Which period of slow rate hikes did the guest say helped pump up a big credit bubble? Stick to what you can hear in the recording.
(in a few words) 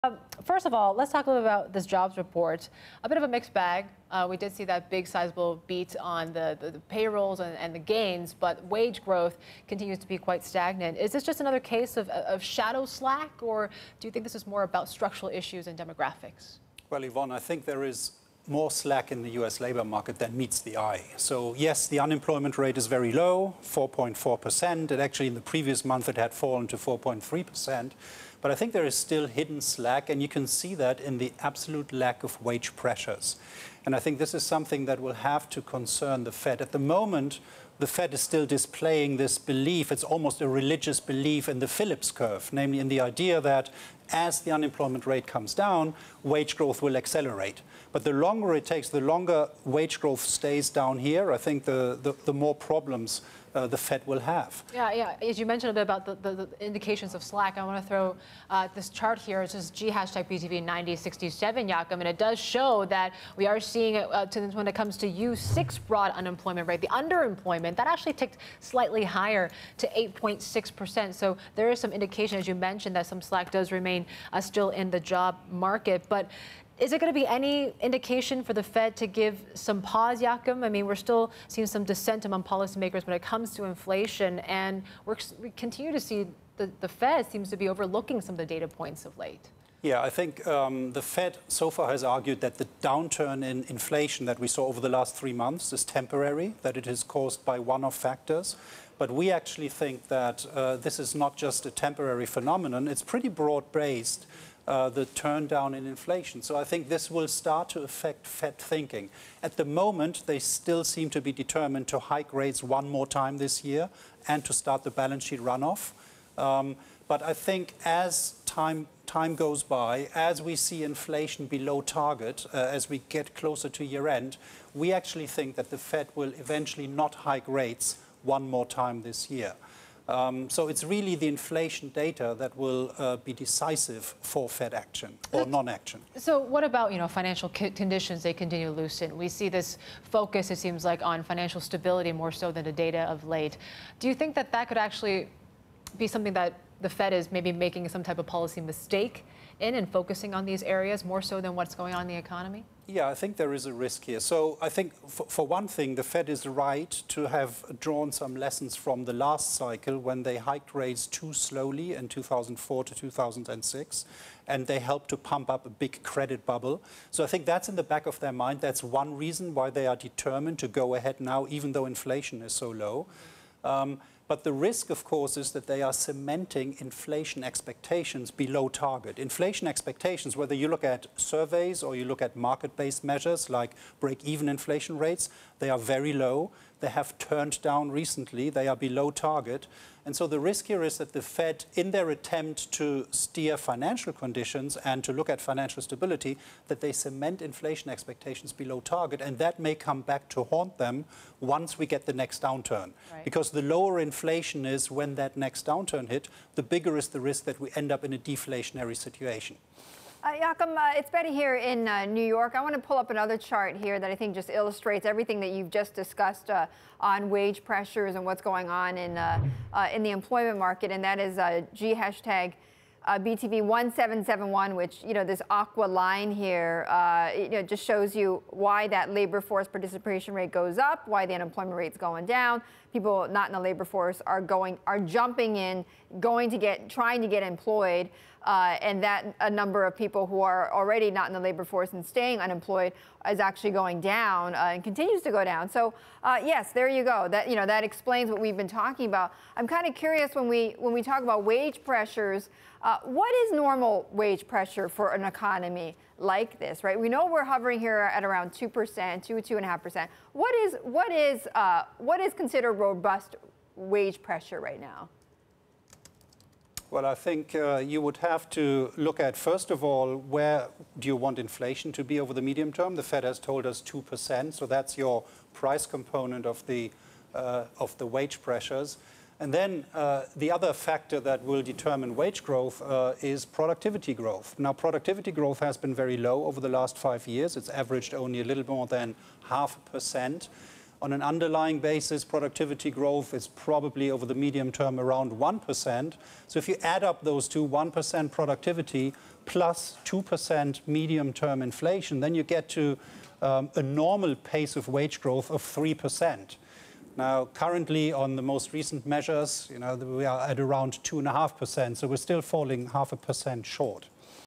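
2004 to 2006.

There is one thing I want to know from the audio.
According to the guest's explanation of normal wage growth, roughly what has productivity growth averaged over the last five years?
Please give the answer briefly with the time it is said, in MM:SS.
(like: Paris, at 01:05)
a little more than half a percent, at 04:48.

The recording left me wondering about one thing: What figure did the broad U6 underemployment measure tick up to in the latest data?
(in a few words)
8.6%.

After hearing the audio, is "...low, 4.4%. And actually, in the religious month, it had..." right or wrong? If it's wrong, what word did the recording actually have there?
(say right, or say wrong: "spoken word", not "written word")
wrong: "previous", not "religious".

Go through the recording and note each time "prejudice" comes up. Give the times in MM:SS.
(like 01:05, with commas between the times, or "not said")
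not said.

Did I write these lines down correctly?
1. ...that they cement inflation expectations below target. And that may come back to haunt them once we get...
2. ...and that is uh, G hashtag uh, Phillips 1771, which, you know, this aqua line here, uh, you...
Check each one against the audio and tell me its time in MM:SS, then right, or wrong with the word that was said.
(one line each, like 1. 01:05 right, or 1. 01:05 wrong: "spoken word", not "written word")
1. 03:16 right
2. 03:40 wrong: "BTV", not "Phillips".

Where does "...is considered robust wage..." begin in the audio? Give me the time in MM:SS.
04:22.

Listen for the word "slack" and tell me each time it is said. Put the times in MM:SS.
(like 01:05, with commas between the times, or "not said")
00:12, 00:18, 00:29, 00:57, 01:13.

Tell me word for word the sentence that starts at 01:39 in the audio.
But we actually think that uh, this is not just a temporary phenomenon.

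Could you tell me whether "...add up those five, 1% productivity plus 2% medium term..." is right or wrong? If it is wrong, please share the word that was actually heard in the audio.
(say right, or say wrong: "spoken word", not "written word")
wrong: "two", not "five".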